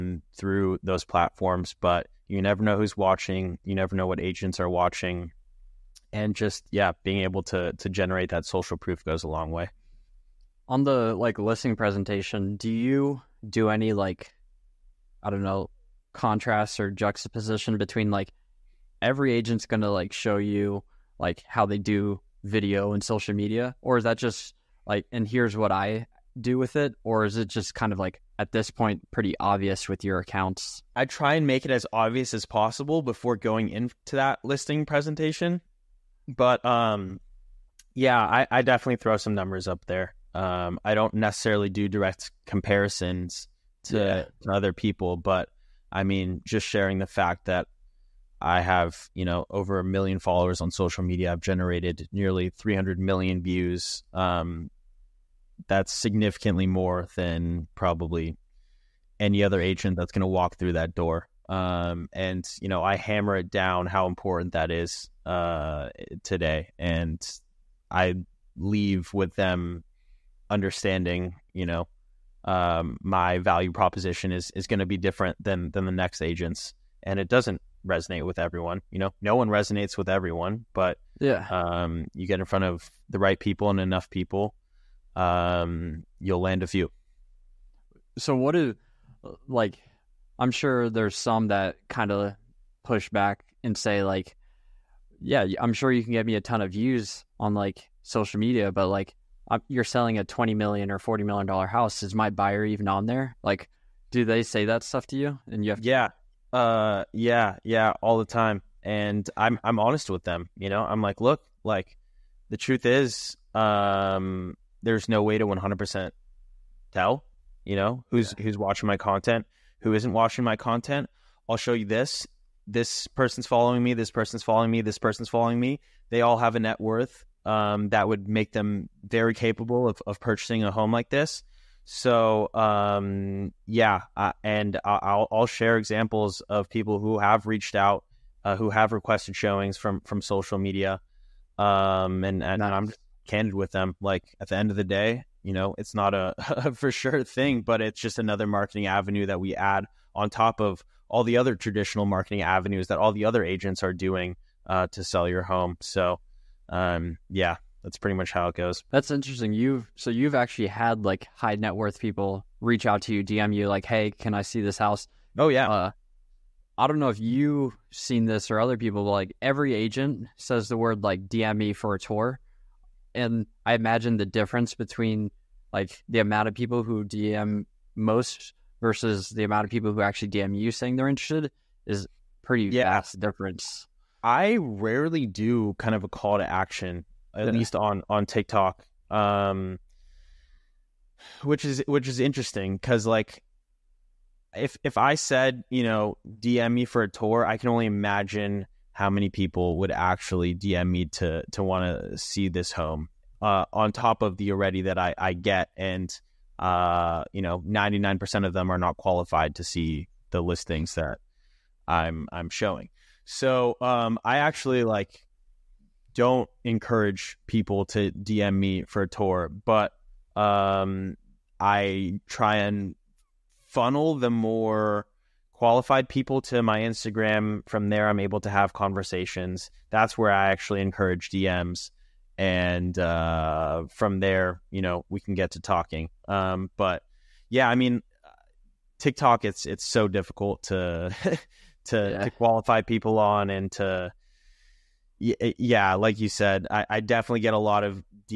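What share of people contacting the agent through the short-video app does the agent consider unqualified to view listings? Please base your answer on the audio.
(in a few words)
99 percent.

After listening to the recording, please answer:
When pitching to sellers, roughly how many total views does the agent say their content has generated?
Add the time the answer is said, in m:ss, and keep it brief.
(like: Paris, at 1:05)
nearly 300 million, at 0:52.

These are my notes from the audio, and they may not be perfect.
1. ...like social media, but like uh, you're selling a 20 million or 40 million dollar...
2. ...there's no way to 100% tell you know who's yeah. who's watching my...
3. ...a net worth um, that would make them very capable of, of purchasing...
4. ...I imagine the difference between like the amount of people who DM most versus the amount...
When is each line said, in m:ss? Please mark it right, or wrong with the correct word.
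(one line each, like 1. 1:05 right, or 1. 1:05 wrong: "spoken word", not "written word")
1. 1:37 right
2. 1:54 right
3. 2:06 right
4. 2:53 right.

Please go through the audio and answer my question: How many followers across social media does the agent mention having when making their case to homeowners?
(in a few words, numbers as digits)
over 1 million.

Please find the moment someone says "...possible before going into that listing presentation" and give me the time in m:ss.
0:32.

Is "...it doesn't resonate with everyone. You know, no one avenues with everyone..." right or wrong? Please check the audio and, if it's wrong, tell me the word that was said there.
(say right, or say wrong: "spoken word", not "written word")
wrong: "resonates", not "avenues".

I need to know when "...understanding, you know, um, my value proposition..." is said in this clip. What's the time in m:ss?
1:10.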